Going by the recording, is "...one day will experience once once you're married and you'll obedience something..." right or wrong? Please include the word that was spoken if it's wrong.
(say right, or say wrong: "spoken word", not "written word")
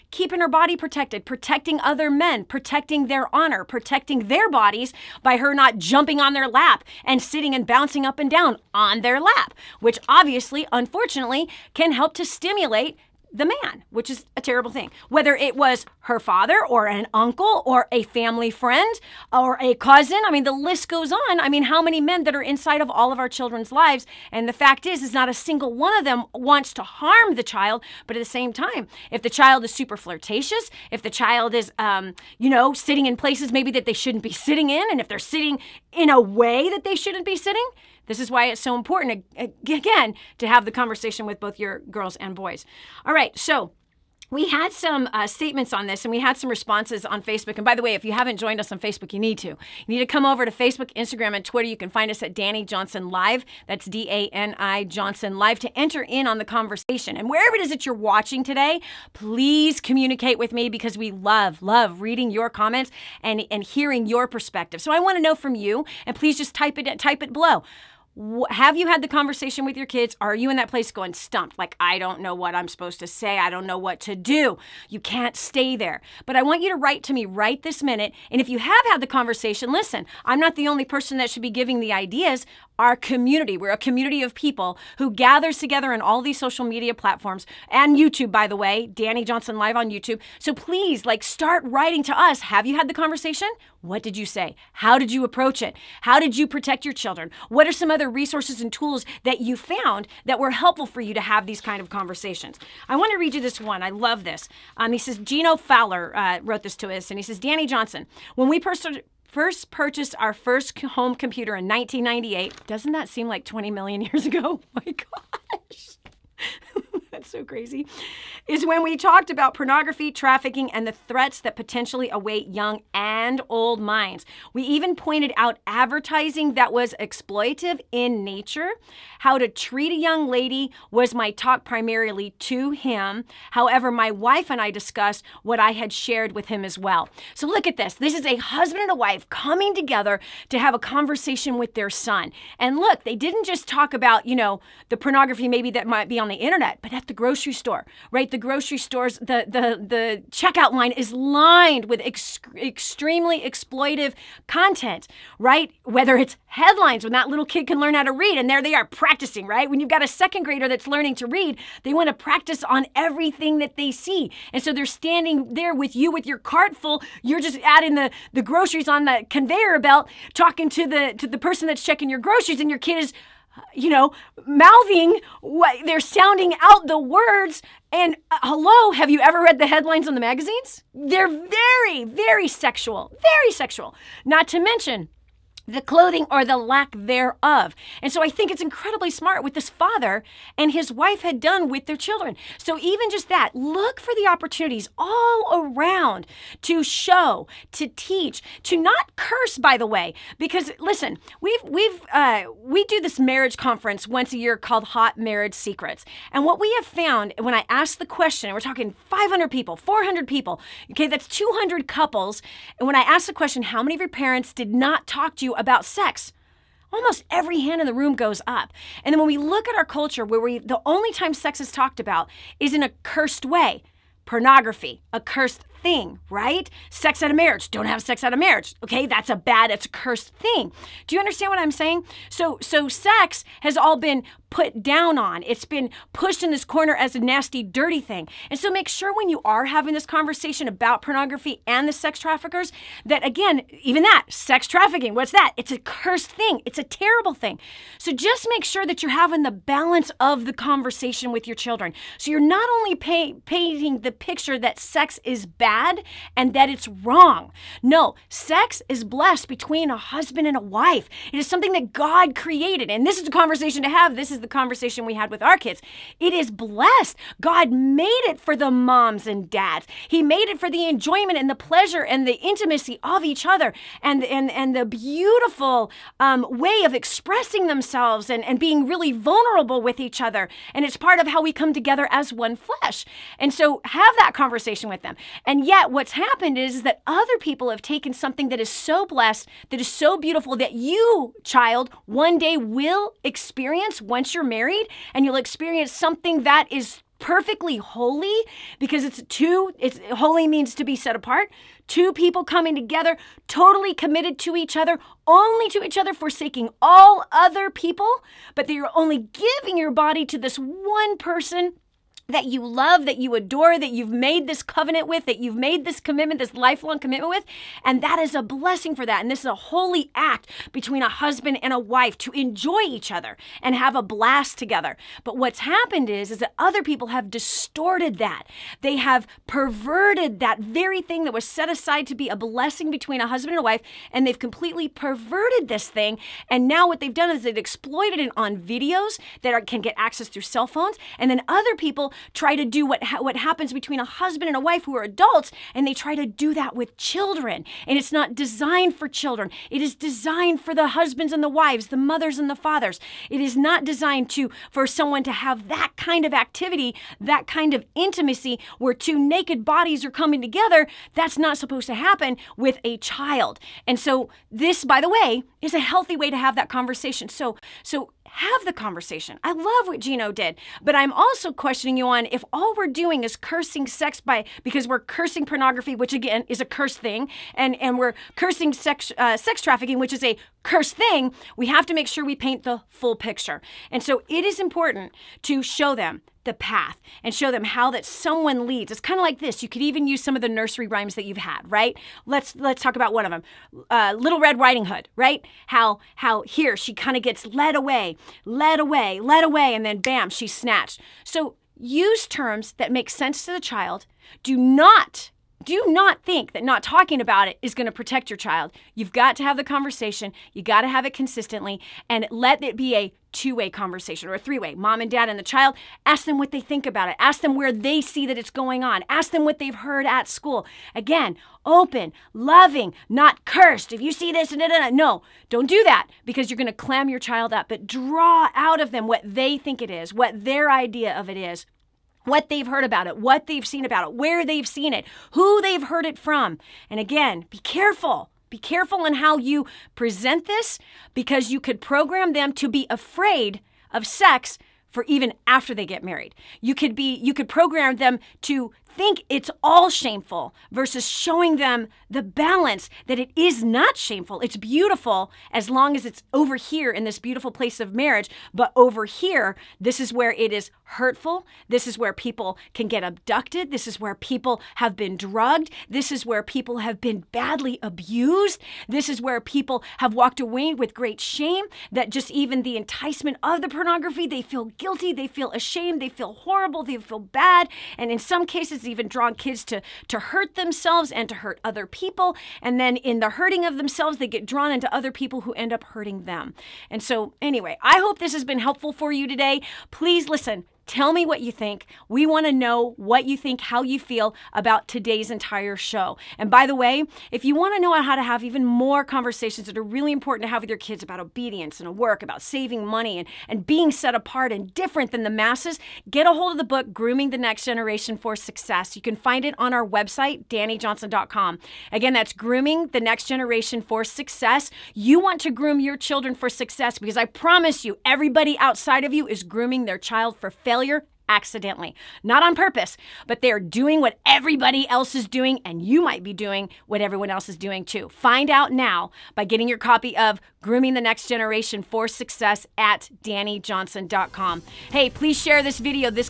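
wrong: "experience", not "obedience".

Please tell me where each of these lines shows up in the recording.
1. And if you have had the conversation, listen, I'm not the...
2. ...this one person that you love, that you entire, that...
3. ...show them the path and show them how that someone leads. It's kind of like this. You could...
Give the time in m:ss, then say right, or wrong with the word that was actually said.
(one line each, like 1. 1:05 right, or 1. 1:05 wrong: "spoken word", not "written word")
1. 1:18 right
2. 5:10 wrong: "adore", not "entire"
3. 6:25 right.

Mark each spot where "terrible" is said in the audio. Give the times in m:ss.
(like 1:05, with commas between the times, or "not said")
0:14, 4:06.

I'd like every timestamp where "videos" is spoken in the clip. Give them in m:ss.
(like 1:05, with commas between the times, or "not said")
5:38, 8:55.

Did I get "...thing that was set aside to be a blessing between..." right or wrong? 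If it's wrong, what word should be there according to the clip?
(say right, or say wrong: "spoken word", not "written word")
right.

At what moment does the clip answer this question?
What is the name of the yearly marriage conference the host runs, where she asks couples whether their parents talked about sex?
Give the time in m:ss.
3:24.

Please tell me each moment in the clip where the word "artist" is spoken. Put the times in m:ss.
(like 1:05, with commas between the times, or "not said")
not said.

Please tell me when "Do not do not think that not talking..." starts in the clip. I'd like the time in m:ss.
6:44.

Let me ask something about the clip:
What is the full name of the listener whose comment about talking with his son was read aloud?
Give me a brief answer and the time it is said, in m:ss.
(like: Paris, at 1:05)
Gino Fowler, at 1:45.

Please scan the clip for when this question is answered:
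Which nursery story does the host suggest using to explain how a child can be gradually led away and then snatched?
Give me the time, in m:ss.
6:34.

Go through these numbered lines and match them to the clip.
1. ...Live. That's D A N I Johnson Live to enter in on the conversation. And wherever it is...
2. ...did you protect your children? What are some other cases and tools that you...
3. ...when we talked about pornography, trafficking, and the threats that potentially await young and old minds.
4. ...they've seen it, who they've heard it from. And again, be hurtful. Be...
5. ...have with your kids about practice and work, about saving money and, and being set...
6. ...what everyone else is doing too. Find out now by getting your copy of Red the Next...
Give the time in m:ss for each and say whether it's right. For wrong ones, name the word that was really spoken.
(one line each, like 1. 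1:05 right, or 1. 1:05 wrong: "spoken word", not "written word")
1. 0:53 right
2. 1:36 wrong: "resources", not "cases"
3. 1:58 right
4. 7:14 wrong: "careful", not "hurtful"
5. 8:20 wrong: "obedience", not "practice"
6. 8:46 wrong: "Grooming", not "Red".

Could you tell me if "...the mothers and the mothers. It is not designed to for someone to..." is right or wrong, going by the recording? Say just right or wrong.
wrong.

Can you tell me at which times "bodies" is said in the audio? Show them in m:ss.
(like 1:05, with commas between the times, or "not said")
0:04, 5:59.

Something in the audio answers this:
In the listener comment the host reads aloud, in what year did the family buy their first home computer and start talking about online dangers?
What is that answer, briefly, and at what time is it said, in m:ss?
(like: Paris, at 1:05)
1998, at 1:51.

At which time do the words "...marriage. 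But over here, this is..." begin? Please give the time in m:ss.
7:37.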